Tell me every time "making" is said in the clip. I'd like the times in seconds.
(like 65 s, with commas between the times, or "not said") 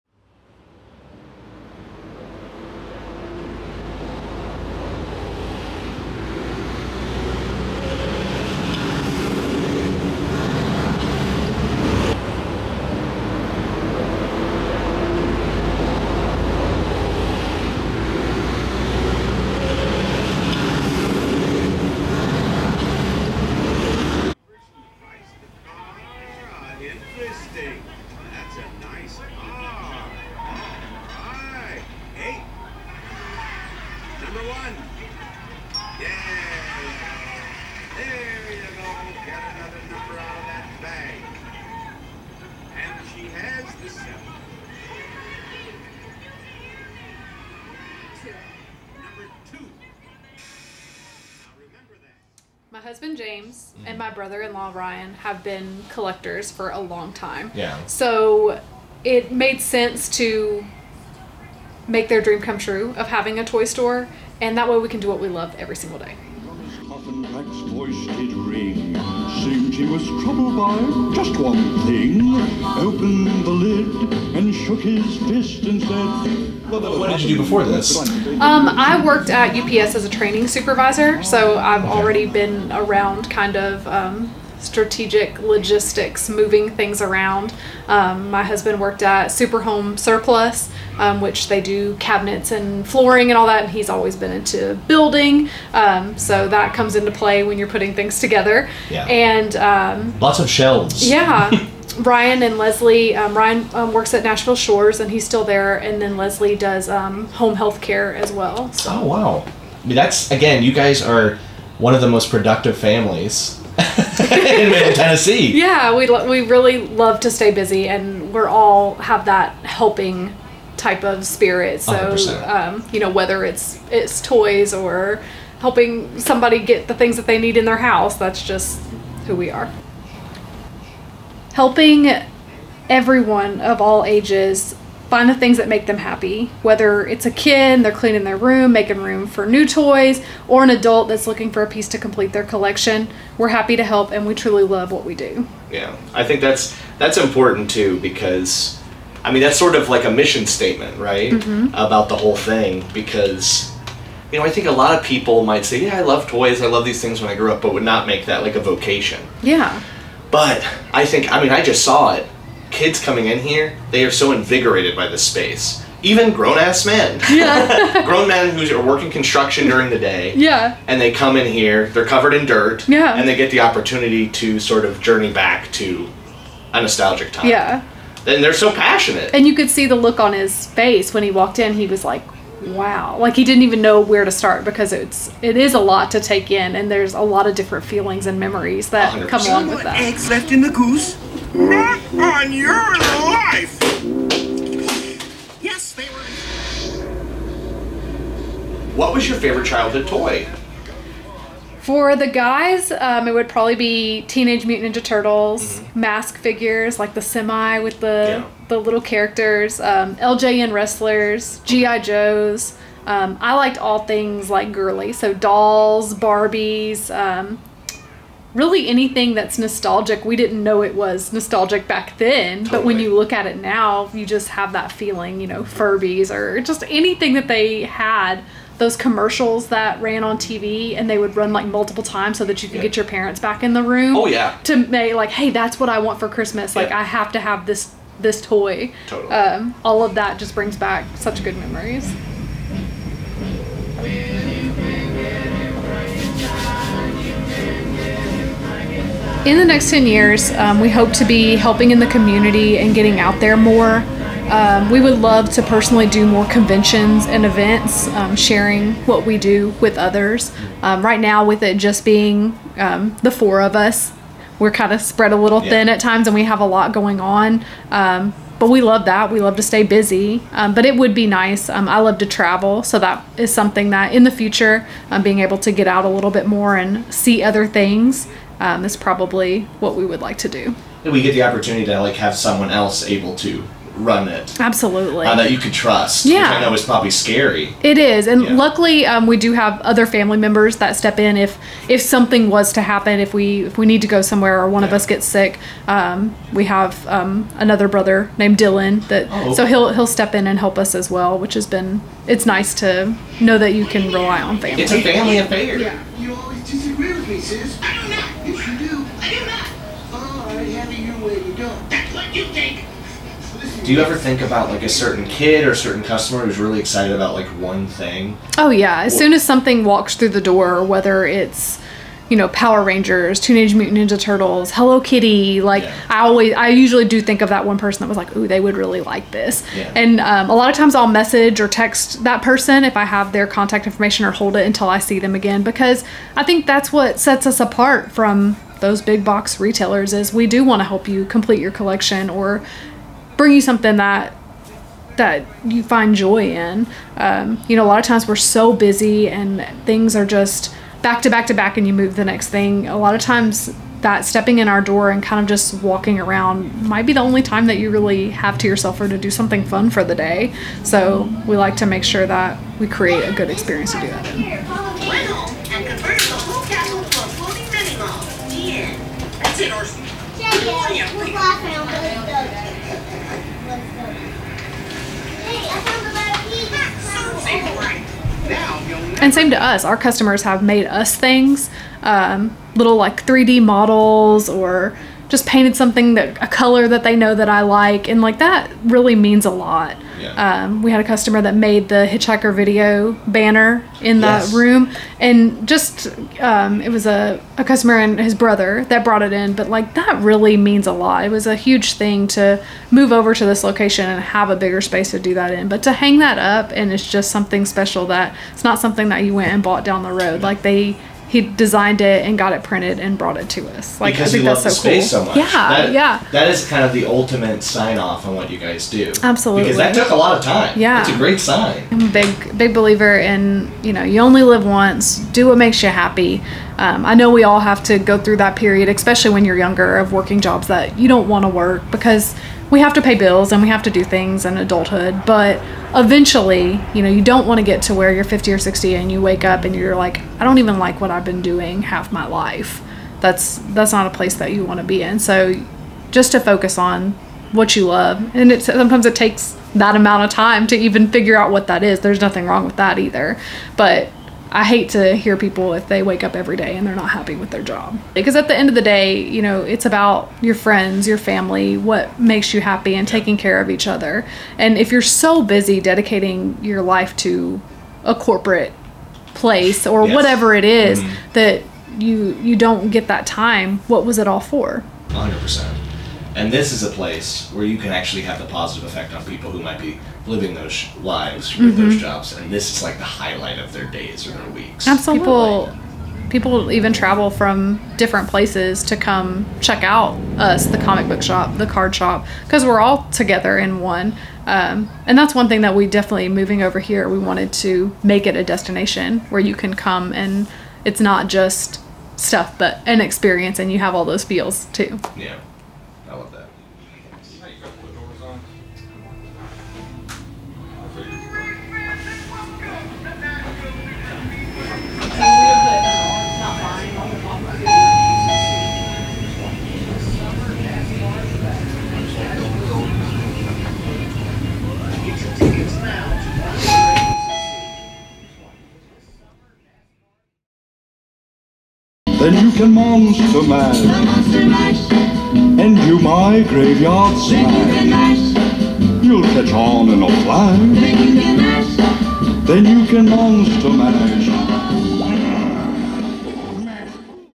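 138 s.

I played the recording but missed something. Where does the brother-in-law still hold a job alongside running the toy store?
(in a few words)
Nashville Shores.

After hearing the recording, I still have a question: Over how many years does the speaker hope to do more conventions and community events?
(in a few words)
10 years.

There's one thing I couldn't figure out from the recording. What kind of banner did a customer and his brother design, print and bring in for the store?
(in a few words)
Hitchhiker video banner.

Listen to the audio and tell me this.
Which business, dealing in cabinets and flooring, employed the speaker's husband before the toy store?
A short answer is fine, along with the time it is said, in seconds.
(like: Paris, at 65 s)
Superhome Surplus, at 89 s.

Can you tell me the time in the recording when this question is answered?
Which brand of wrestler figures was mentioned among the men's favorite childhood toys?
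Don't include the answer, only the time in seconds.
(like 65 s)
210 s.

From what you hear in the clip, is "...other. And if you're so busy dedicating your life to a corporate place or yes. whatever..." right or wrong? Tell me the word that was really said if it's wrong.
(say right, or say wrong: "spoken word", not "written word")
right.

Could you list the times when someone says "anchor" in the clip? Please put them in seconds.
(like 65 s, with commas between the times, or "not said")
not said.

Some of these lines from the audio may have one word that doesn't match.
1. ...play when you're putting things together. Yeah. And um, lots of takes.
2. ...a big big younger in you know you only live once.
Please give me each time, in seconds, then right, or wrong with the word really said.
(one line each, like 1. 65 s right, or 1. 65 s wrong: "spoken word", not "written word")
1. 97 s wrong: "shelves", not "takes"
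2. 422 s wrong: "believer", not "younger".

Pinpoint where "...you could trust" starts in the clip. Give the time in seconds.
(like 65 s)
285 s.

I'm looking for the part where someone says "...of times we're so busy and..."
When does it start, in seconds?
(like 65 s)
347 s.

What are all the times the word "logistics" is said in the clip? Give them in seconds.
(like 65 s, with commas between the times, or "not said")
85 s.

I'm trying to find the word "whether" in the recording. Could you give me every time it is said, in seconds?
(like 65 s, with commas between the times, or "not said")
123 s, 136 s, 320 s.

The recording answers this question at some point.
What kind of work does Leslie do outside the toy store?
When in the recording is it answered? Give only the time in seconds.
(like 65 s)
106 s.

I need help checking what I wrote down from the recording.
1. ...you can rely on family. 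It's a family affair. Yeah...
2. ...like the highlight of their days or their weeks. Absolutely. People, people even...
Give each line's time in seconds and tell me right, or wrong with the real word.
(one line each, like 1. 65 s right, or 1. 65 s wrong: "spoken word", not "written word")
1. 303 s right
2. 482 s right.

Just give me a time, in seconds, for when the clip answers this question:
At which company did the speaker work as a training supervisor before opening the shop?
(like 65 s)
79 s.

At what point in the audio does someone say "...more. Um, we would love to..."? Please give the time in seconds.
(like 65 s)
253 s.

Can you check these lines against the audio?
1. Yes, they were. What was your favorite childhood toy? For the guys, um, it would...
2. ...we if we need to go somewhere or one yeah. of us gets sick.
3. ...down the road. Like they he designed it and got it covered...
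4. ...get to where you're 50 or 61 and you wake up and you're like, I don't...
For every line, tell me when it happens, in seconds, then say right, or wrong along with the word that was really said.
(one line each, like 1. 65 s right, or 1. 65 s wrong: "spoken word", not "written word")
1. 195 s right
2. 293 s right
3. 409 s wrong: "printed", not "covered"
4. 437 s wrong: "60", not "61".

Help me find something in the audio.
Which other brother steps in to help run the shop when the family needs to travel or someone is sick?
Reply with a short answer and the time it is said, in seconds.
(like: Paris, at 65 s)
Dylan, at 298 s.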